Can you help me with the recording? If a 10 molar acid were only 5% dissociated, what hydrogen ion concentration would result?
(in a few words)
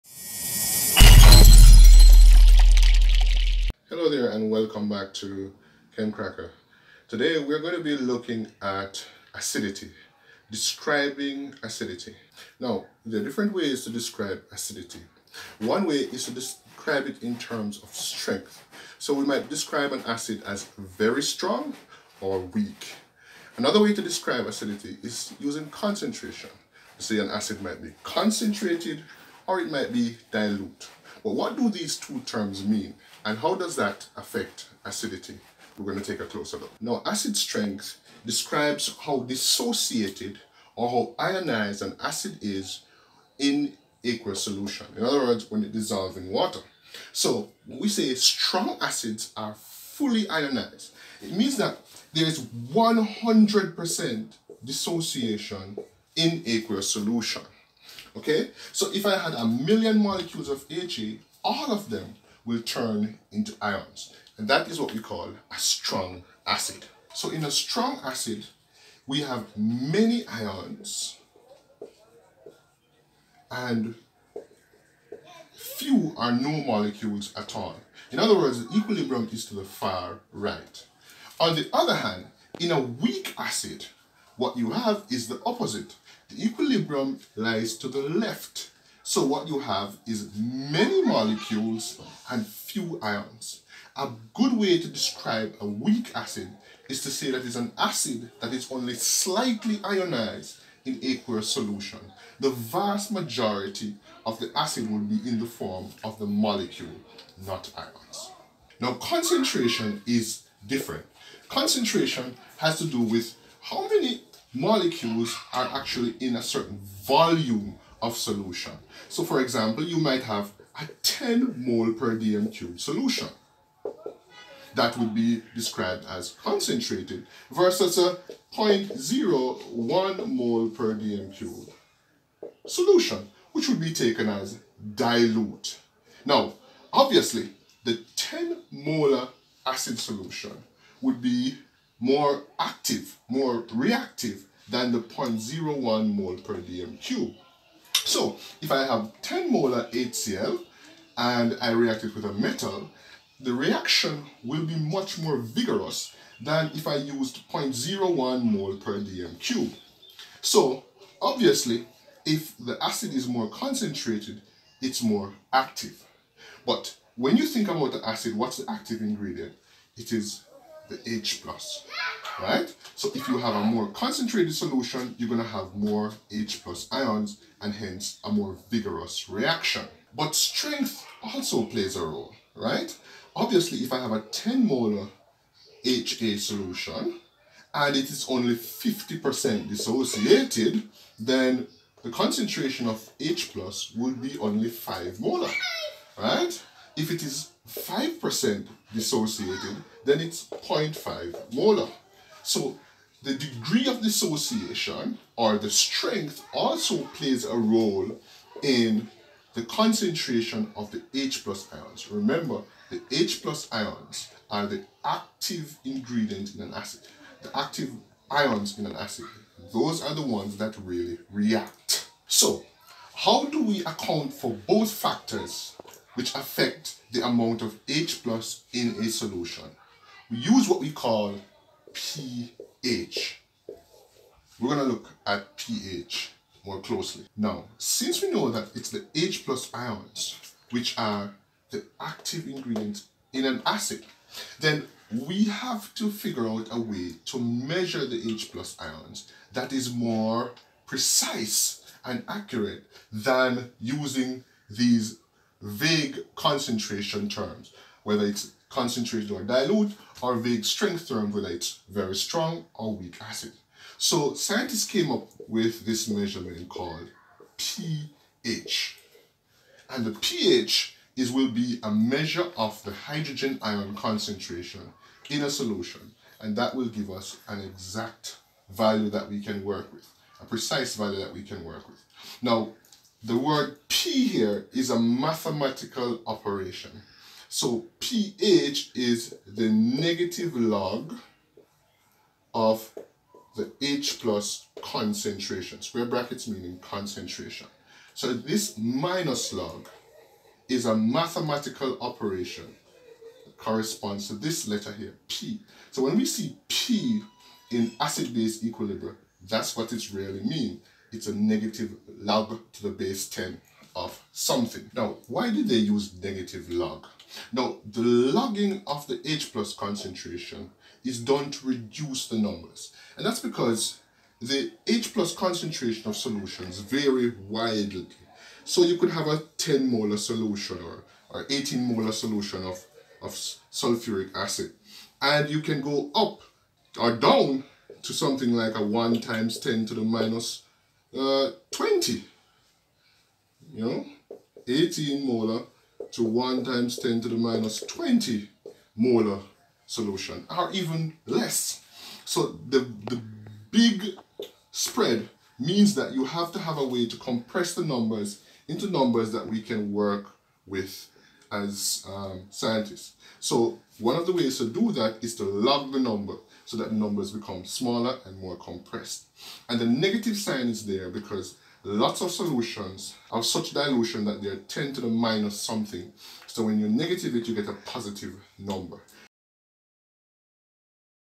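0.5 molar.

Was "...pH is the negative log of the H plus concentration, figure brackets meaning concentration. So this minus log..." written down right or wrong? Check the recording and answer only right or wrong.
wrong.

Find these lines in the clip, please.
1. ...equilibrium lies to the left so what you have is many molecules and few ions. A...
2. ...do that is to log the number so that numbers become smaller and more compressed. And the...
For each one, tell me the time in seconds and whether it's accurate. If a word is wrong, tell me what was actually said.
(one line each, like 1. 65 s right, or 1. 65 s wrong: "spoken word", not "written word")
1. 86 s right
2. 364 s right.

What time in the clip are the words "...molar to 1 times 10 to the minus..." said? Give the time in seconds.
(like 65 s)
345 s.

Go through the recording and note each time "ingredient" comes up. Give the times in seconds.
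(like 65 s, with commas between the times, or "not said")
169 s, 215 s, 242 s.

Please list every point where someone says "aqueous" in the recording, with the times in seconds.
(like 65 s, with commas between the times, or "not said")
44 s, 56 s, 101 s.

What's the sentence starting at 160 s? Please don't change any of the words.
So obviously, if the acid is more concentrated, it's more active.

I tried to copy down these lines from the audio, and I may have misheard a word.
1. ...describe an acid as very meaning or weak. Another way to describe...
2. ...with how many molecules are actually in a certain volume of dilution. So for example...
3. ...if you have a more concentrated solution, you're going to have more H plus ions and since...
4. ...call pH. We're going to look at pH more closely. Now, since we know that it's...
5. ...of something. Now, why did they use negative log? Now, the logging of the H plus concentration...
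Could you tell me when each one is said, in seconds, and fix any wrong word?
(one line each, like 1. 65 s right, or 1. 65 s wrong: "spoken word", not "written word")
1. 19 s wrong: "strong", not "meaning"
2. 113 s wrong: "solution", not "dilution"
3. 173 s wrong: "hence", not "since"
4. 230 s right
5. 313 s right.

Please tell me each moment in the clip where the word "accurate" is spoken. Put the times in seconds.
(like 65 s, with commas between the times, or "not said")
252 s.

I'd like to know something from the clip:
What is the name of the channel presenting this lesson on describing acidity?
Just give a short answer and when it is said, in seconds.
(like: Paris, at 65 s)
ChemCracker, at 5 s.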